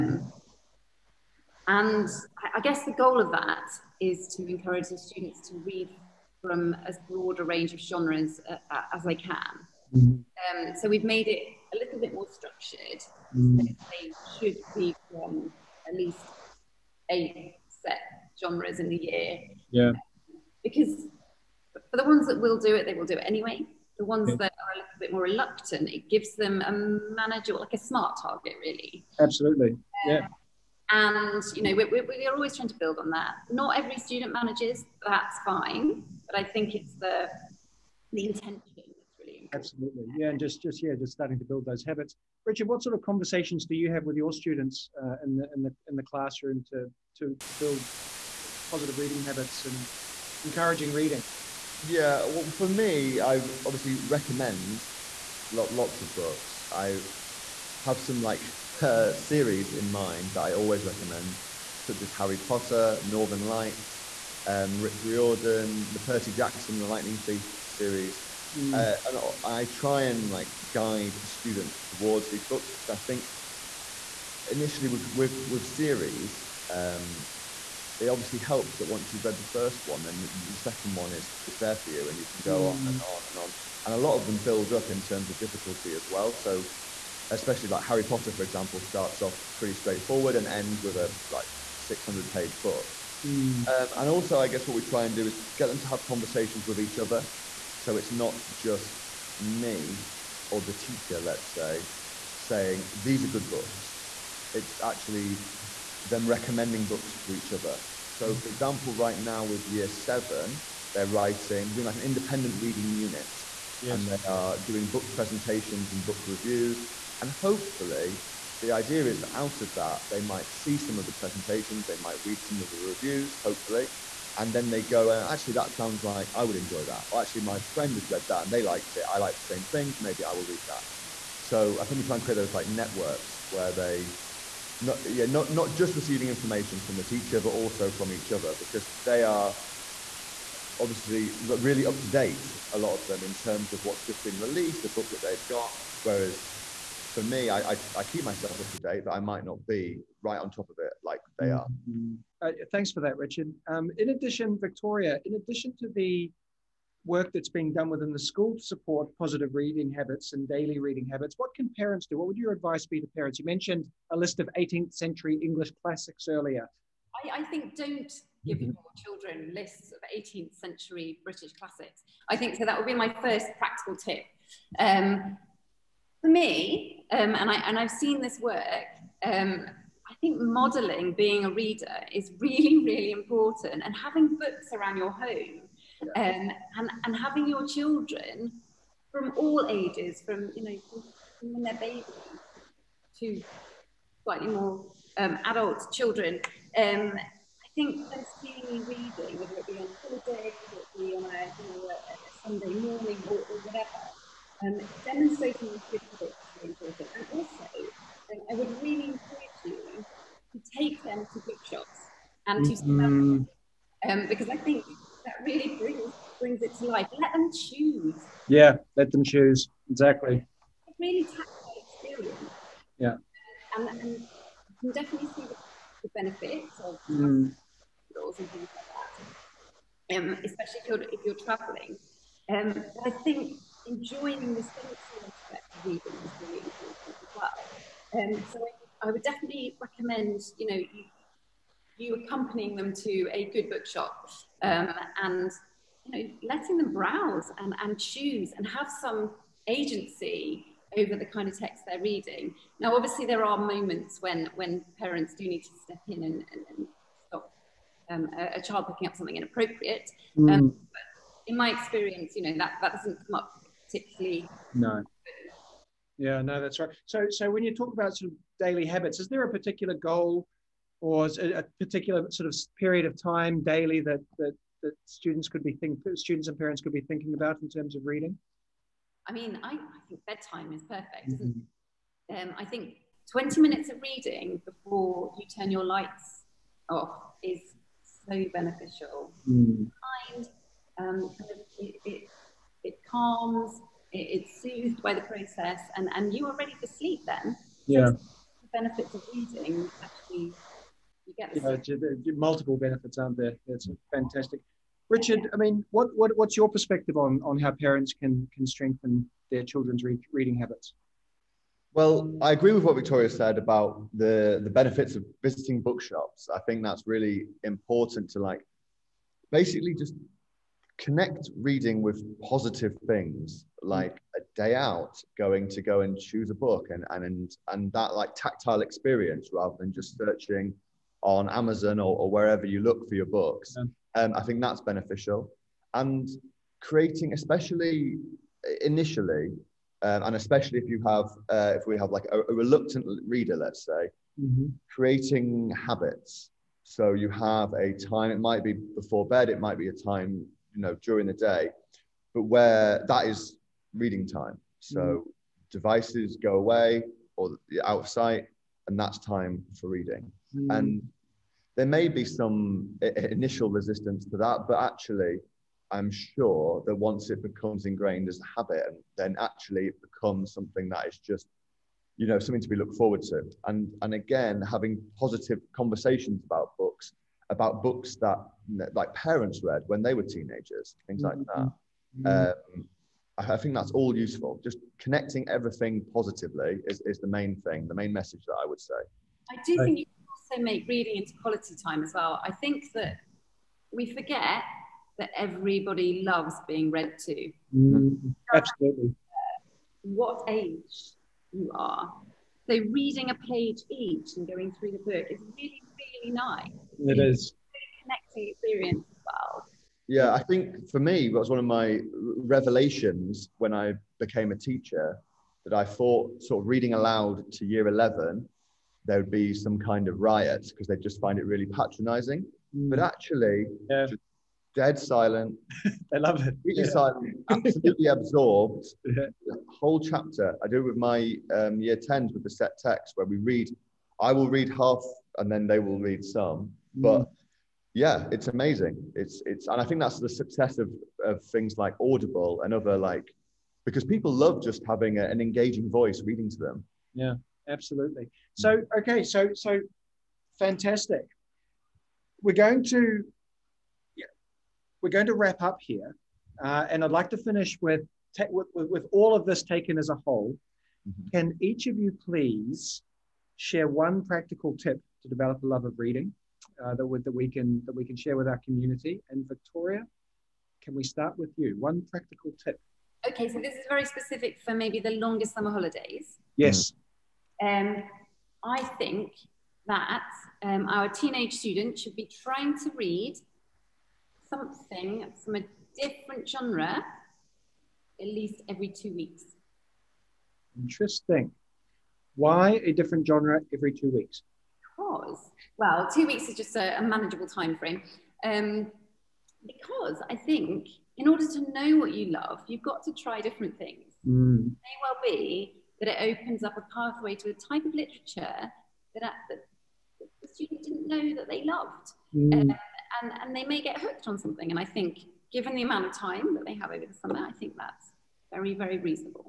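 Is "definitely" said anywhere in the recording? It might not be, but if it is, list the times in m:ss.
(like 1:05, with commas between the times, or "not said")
3:45, 3:59.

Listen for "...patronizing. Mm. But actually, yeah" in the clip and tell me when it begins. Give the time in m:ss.
7:01.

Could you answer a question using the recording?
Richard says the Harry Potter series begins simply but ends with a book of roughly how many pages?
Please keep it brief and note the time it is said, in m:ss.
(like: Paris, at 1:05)
600, at 1:31.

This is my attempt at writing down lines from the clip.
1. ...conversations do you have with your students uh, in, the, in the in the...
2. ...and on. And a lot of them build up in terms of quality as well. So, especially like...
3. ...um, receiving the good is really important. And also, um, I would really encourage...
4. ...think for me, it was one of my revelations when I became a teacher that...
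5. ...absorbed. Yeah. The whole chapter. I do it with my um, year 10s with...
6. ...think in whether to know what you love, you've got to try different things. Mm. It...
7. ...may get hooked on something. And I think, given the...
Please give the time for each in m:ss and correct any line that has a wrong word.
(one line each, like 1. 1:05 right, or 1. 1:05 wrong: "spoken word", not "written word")
1. 0:43 right
2. 1:23 wrong: "difficulty", not "quality"
3. 3:24 wrong: "demonstrating", not "receiving"
4. 6:50 right
5. 7:08 right
6. 8:20 wrong: "order", not "whether"
7. 8:33 right.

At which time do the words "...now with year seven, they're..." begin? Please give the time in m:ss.
1:49.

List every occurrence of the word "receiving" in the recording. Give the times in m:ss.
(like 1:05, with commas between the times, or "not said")
2:15.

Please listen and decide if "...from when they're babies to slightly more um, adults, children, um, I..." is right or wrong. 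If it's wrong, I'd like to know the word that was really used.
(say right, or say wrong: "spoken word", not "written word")
right.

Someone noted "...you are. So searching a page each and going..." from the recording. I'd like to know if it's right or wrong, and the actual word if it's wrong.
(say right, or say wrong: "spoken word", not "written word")
wrong: "reading", not "searching".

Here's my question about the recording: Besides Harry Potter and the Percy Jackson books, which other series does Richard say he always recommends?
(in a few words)
Northern Lights.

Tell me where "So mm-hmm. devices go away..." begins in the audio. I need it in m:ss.
5:54.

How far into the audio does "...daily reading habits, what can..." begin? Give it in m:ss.
2:40.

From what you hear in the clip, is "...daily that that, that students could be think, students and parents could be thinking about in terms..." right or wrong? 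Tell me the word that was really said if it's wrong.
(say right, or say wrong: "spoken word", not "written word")
right.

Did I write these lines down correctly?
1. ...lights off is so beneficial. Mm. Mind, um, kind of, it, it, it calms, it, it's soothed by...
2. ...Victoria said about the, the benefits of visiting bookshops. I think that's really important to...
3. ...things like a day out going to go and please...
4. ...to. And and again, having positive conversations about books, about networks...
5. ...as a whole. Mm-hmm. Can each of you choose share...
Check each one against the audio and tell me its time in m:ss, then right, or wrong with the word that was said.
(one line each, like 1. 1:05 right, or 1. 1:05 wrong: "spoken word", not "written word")
1. 4:45 right
2. 5:12 right
3. 5:23 wrong: "choose", not "please"
4. 6:13 wrong: "books", not "networks"
5. 7:39 wrong: "please", not "choose".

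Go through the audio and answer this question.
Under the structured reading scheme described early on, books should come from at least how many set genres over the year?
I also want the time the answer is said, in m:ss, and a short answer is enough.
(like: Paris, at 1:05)
8, at 0:17.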